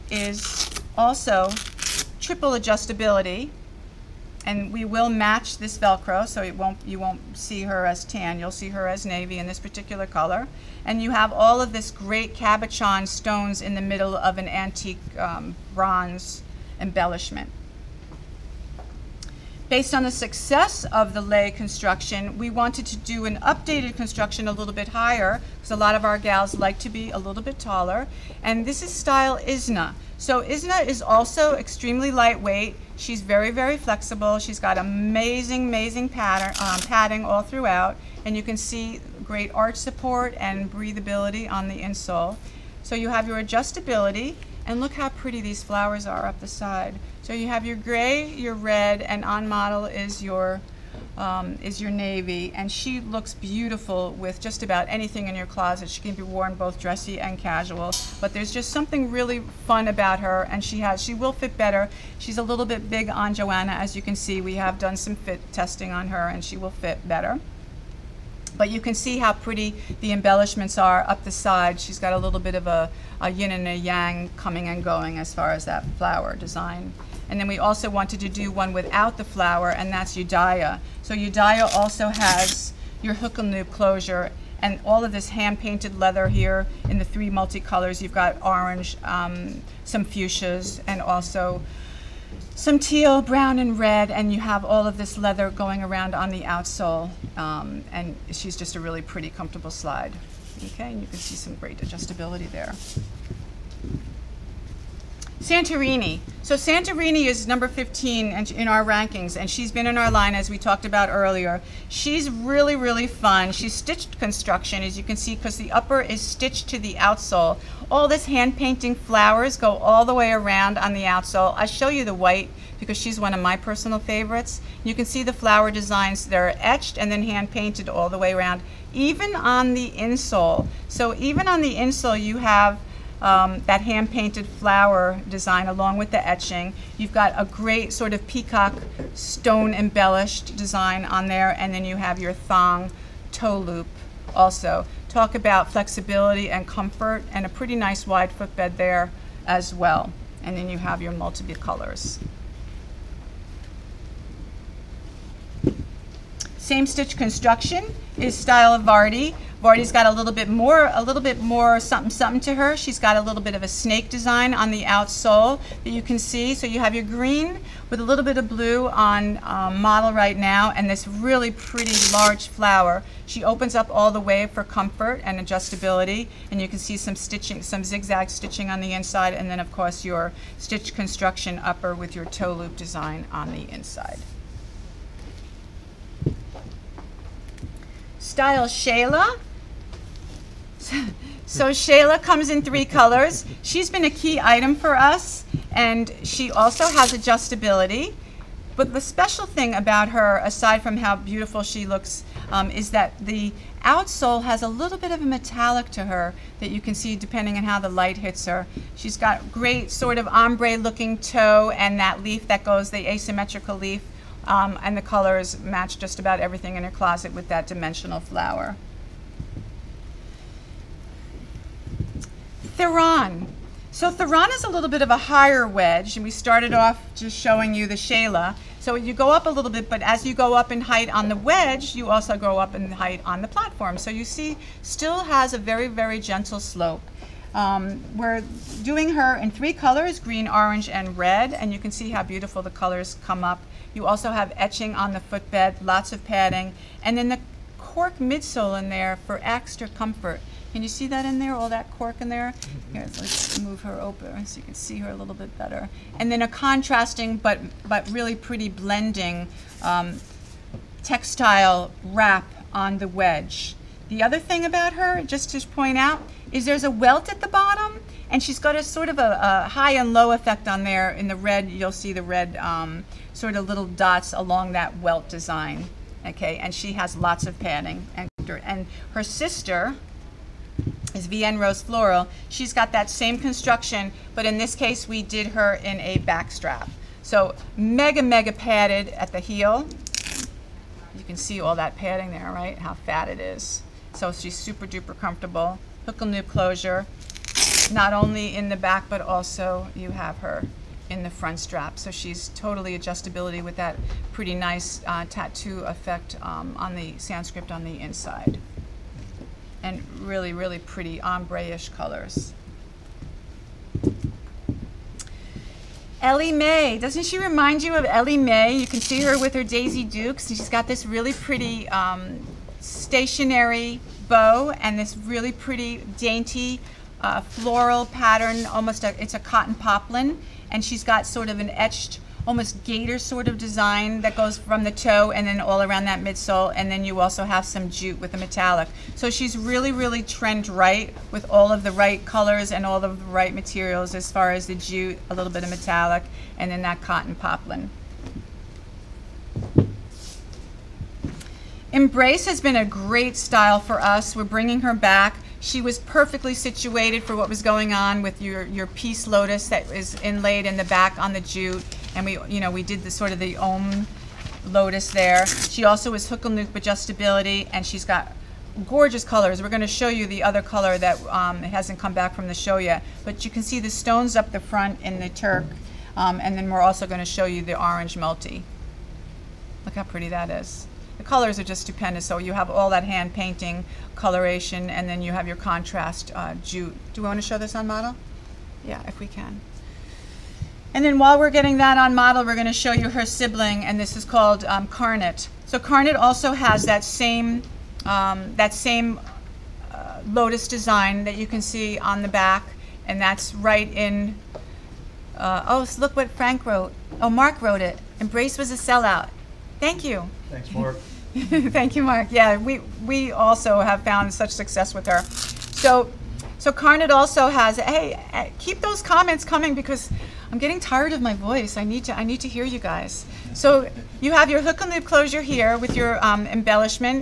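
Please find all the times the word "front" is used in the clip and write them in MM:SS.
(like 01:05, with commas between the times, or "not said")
05:01, 06:14.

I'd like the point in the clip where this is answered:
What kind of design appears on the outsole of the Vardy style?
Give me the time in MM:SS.
02:43.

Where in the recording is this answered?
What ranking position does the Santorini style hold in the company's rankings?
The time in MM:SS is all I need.
01:47.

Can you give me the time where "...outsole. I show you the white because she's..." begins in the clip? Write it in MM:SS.
02:01.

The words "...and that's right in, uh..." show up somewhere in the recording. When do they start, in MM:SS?
06:43.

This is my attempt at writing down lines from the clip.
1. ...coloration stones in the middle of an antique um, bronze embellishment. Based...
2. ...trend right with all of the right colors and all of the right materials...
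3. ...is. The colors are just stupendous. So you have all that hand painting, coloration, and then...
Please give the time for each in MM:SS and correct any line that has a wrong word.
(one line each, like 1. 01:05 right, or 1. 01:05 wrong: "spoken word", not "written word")
1. 00:12 wrong: "cabochon", not "coloration"
2. 05:40 right
3. 06:20 right.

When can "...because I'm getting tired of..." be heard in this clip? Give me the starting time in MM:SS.
06:59.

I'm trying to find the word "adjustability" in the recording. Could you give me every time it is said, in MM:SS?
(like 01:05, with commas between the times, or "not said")
00:02, 00:43, 01:41, 02:55, 03:17, 05:02, 06:06.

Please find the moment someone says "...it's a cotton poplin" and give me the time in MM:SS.
05:29.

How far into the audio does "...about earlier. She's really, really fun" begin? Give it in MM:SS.
01:50.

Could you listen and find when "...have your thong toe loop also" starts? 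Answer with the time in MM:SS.
02:21.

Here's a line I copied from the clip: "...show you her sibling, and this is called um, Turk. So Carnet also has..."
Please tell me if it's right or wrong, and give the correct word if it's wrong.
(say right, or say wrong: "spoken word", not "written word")
wrong: "Carnet", not "Turk".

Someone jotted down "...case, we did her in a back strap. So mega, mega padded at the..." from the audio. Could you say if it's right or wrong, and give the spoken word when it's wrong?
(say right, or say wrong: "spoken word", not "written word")
right.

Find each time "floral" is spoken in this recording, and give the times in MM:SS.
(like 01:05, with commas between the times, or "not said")
04:41, 05:27.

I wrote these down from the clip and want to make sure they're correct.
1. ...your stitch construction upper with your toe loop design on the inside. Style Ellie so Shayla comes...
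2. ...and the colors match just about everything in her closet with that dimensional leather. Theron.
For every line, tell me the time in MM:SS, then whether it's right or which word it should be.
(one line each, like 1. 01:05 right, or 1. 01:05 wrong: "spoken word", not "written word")
1. 03:00 wrong: "Shayla", not "Ellie"
2. 03:34 wrong: "flower", not "leather".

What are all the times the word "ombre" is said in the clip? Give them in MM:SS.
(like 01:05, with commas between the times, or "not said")
03:30, 05:11.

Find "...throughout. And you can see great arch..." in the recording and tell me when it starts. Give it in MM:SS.
00:37.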